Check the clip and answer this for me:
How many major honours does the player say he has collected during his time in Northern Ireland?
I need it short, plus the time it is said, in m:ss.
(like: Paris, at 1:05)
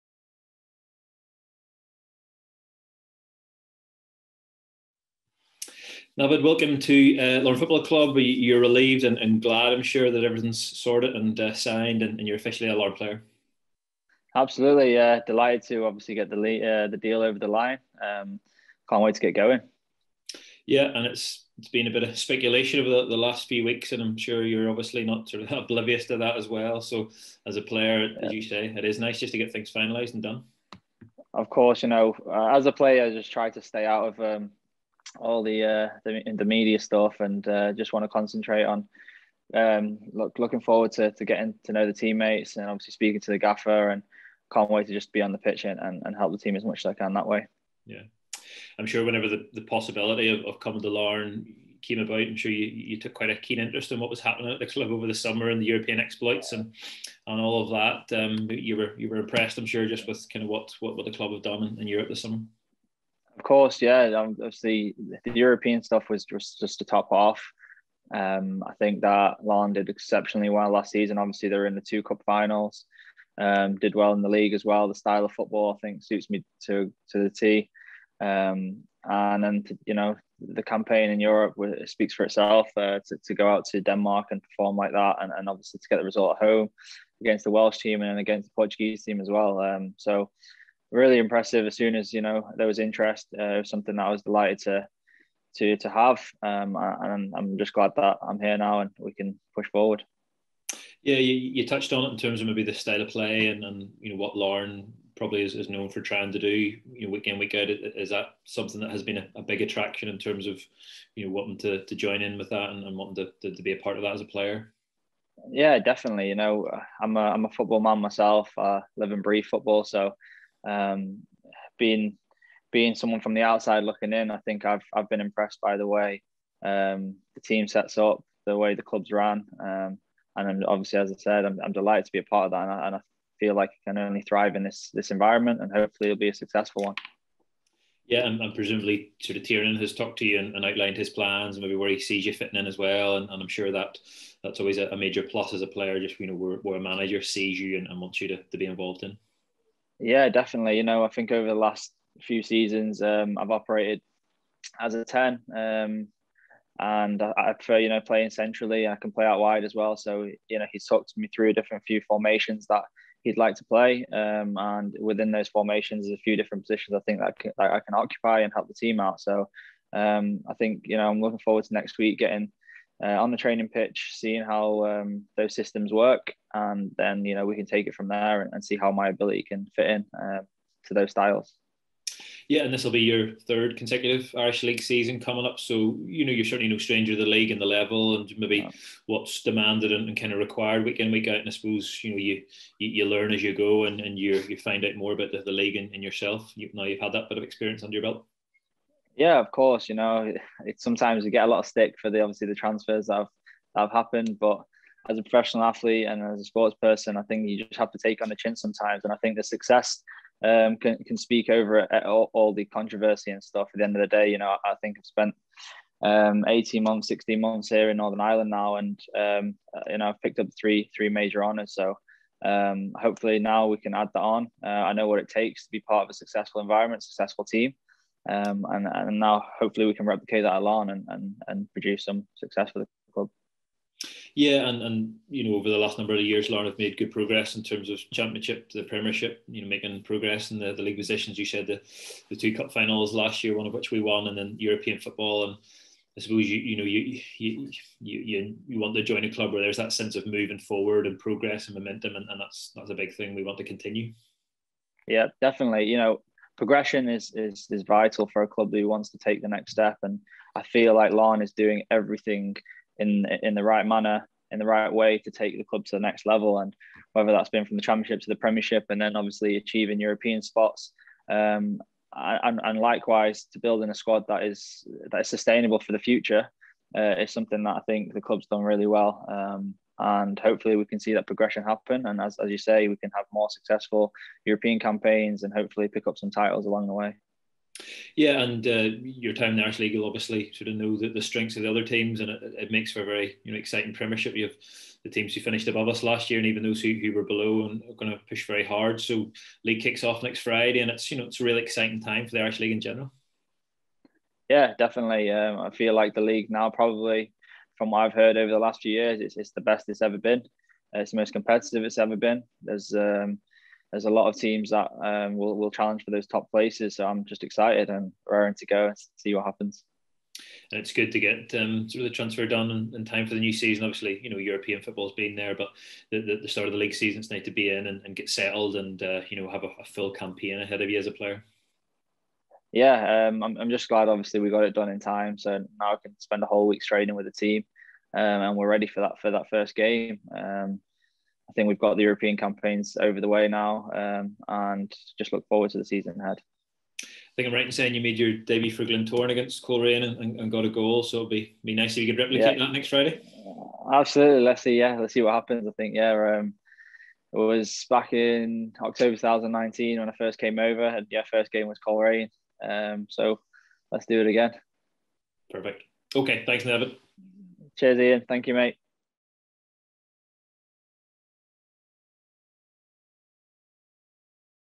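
3, at 3:40.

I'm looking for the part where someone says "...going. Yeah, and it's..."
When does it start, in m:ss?
0:19.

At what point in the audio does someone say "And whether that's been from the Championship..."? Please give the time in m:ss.
4:26.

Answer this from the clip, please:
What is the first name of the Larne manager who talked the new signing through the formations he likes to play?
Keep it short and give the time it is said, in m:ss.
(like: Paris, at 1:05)
Tiernan, at 2:19.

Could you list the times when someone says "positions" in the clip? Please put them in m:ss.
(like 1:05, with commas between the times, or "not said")
2:46, 4:00.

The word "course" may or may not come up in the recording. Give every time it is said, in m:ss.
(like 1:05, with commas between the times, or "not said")
0:31, 1:03, 3:19.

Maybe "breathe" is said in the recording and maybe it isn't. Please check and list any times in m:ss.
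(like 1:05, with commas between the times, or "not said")
1:59.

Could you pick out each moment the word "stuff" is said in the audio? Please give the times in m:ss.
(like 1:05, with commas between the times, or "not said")
0:36, 1:05, 3:33.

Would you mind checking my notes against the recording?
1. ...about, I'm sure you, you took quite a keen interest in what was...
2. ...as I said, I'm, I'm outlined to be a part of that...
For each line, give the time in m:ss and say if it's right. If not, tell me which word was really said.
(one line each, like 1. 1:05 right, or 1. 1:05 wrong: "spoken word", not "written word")
1. 0:51 right
2. 2:10 wrong: "delighted", not "outlined".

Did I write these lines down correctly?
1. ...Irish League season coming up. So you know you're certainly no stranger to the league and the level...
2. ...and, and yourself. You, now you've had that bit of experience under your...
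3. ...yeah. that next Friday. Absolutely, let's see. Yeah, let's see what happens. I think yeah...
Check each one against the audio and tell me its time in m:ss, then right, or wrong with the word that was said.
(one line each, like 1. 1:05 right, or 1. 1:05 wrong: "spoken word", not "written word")
1. 3:04 right
2. 3:15 right
3. 5:52 right.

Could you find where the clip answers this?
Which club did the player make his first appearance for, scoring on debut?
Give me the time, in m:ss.
5:48.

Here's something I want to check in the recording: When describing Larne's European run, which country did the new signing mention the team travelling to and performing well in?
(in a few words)
Denmark.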